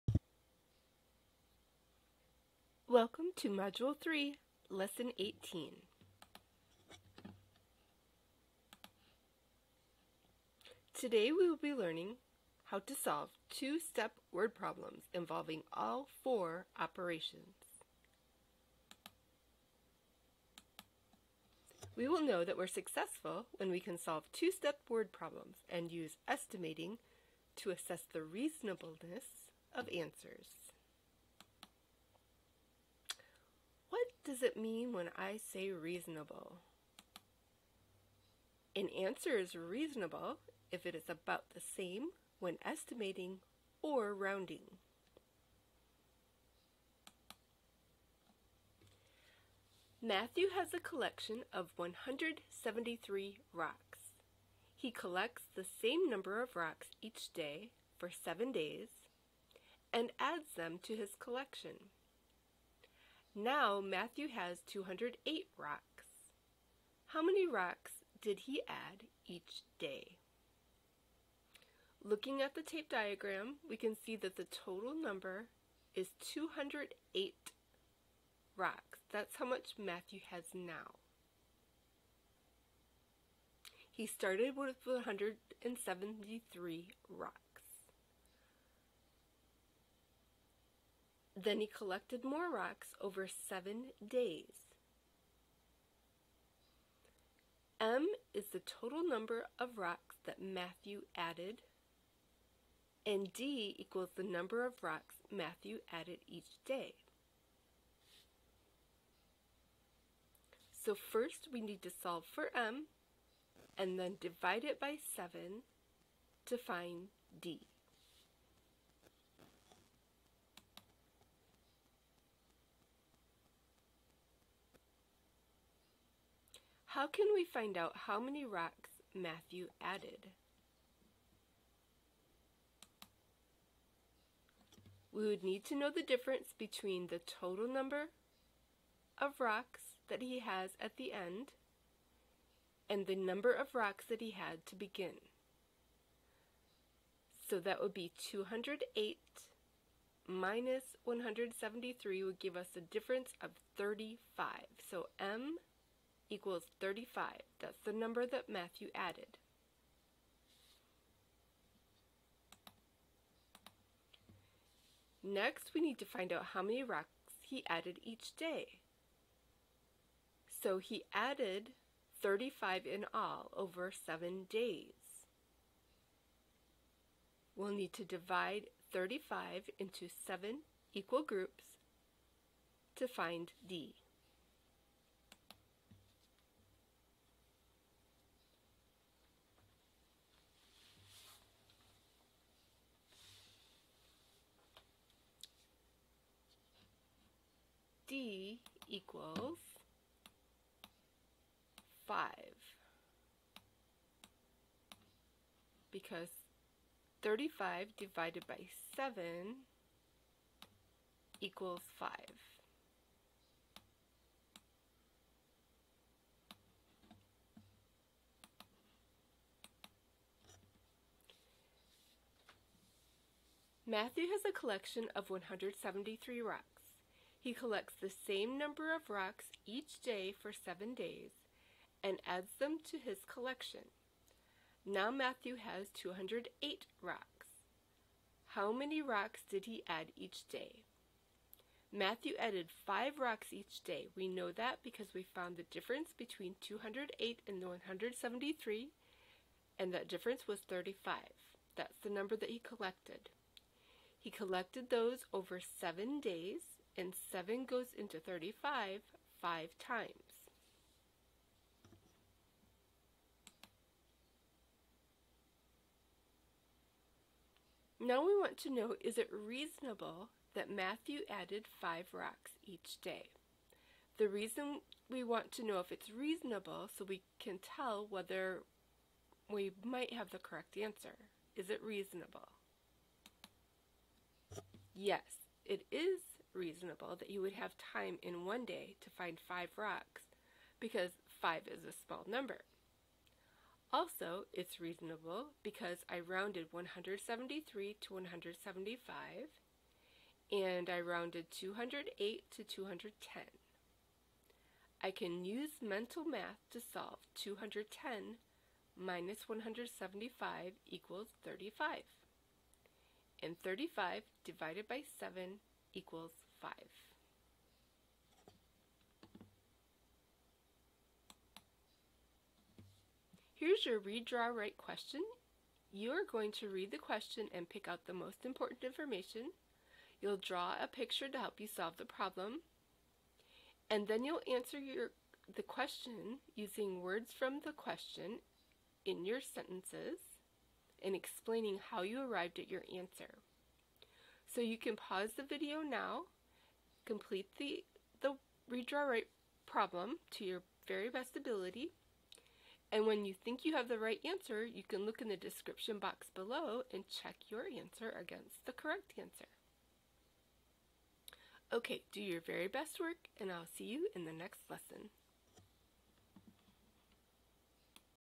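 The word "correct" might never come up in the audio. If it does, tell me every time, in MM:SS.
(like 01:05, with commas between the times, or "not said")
04:40, 05:58.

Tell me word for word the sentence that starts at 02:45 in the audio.
Next, we need to find out how many rocks he added each day.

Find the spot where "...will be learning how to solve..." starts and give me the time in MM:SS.
00:11.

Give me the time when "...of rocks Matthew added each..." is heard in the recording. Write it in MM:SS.
01:44.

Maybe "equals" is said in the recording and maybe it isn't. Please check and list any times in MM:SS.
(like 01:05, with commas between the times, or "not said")
01:43, 02:36, 03:00, 03:18, 03:31, 05:10, 05:15.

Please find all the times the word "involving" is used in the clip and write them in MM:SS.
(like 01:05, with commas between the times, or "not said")
00:15.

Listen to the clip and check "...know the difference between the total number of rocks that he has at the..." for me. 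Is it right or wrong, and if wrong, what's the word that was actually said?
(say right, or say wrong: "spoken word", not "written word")
right.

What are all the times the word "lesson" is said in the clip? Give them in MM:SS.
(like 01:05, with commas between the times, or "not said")
00:04, 06:04.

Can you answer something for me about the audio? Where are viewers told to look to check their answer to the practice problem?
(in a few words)
description box.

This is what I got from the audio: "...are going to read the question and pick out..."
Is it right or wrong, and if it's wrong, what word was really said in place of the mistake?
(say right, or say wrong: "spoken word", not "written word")
right.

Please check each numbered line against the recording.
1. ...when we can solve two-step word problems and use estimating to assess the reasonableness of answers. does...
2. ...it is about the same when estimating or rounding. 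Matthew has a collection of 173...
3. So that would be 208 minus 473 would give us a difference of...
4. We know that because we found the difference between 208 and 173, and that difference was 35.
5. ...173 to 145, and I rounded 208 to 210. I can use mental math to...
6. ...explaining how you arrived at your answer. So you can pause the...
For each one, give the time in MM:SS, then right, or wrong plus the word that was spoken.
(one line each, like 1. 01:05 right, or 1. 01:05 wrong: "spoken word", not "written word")
1. 00:23 right
2. 00:40 right
3. 02:27 wrong: "173", not "473"
4. 04:04 right
5. 04:56 wrong: "175", not "145"
6. 05:41 right.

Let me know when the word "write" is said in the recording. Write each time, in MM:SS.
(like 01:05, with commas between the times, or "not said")
05:24, 05:49.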